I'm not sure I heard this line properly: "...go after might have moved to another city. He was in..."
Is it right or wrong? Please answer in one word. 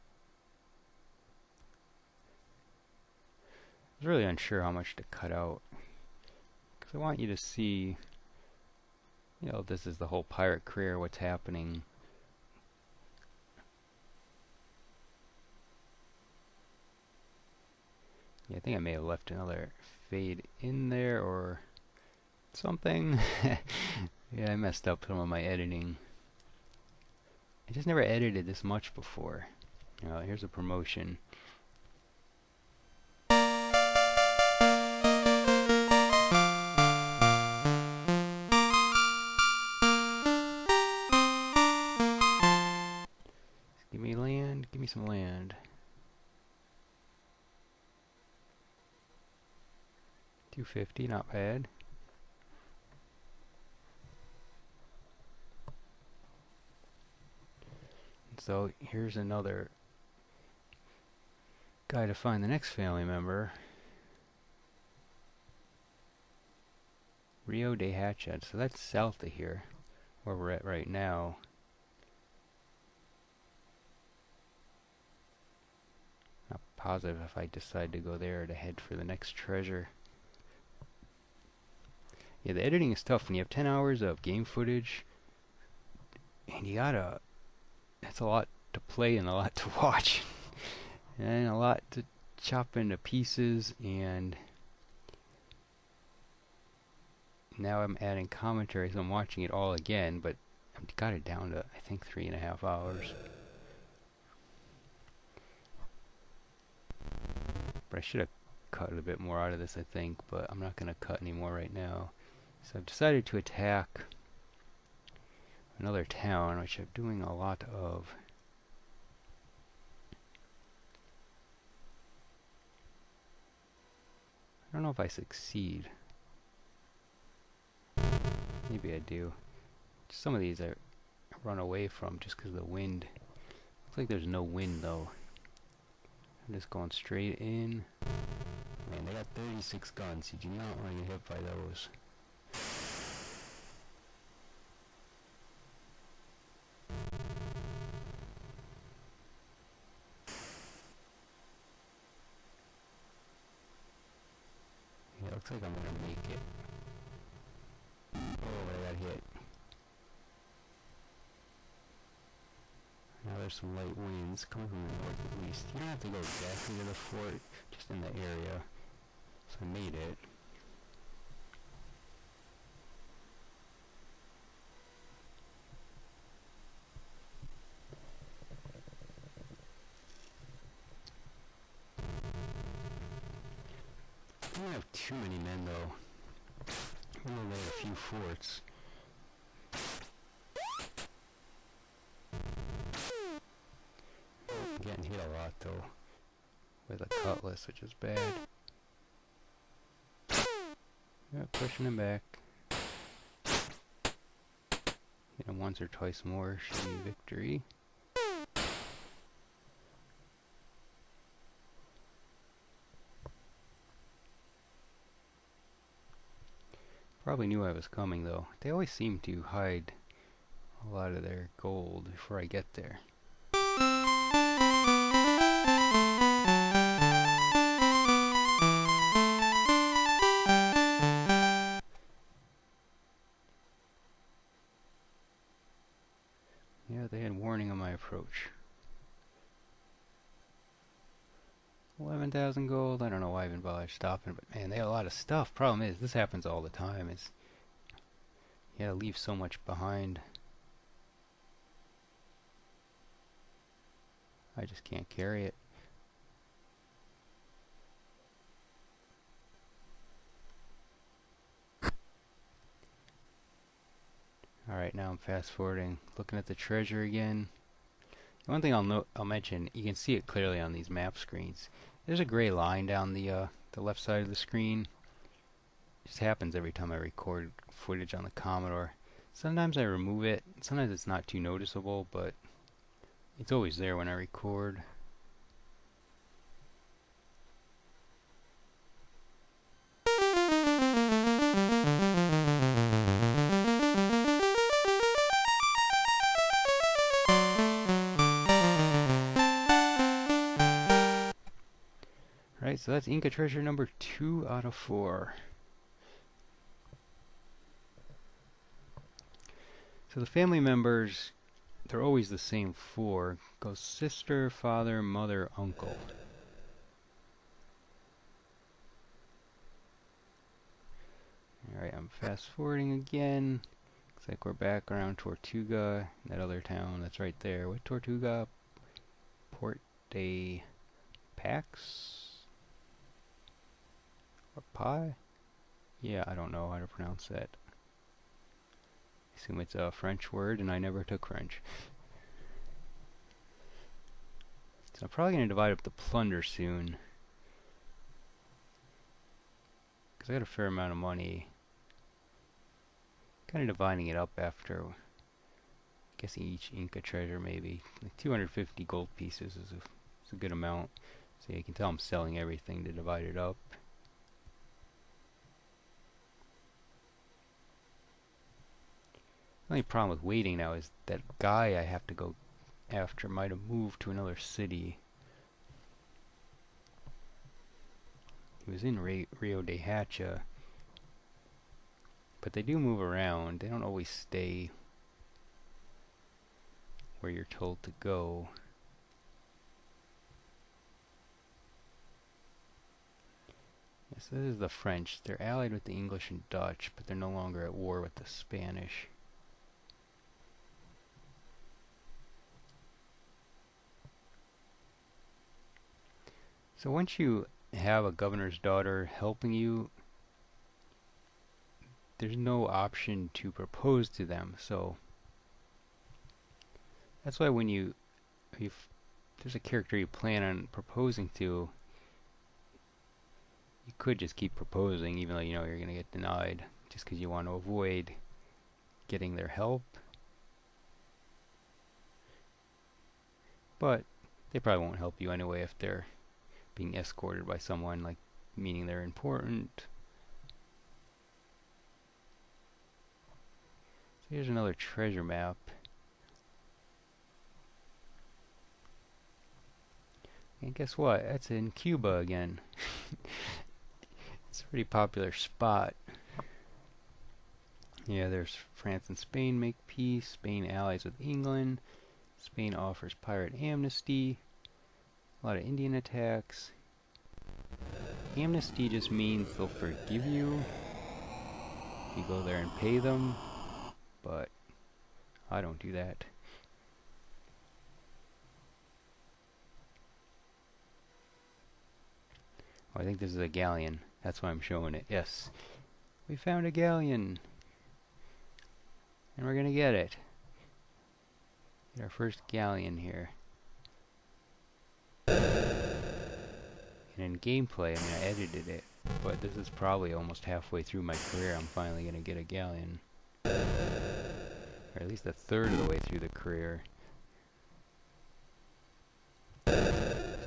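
right.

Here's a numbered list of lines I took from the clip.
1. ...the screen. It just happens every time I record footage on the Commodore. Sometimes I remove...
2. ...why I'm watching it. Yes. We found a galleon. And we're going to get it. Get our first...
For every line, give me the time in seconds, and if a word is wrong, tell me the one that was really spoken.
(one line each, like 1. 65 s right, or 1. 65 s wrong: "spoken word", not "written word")
1. 274 s right
2. 484 s wrong: "showing", not "watching".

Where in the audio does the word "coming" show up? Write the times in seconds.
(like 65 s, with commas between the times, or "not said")
164 s, 217 s.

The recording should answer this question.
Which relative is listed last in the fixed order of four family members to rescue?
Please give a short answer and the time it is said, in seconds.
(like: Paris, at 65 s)
Uncle, at 315 s.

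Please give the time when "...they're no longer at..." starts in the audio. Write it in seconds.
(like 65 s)
397 s.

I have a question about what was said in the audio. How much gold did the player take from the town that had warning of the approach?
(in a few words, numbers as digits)
11,000 gold.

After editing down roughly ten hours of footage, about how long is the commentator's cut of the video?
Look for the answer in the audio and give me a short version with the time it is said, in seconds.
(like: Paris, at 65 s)
3.5 hours, at 102 s.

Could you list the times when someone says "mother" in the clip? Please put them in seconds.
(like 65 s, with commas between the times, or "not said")
315 s.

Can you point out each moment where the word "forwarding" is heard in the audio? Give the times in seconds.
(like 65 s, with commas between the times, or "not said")
265 s, 322 s.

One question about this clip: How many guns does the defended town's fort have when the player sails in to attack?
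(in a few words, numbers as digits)
36.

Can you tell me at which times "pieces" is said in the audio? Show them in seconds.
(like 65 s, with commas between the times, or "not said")
92 s, 359 s.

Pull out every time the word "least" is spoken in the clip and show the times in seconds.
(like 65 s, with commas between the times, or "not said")
165 s, 505 s.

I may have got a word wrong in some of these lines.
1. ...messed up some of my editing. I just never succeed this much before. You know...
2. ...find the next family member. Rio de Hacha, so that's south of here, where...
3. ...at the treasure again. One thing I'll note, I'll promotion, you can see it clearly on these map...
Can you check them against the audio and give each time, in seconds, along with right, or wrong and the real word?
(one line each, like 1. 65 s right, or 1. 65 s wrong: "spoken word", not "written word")
1. 24 s wrong: "edited", not "succeed"
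2. 62 s right
3. 266 s wrong: "mention", not "promotion".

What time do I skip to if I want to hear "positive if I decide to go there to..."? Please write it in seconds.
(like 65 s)
76 s.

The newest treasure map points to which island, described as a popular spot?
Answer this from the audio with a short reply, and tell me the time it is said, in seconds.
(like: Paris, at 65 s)
Cuba, at 451 s.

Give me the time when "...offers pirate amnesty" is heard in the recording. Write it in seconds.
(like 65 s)
462 s.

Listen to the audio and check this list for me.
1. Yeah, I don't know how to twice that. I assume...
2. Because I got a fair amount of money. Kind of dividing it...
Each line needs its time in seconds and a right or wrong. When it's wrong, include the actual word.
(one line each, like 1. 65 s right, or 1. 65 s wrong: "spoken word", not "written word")
1. 336 s wrong: "pronounce", not "twice"
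2. 350 s right.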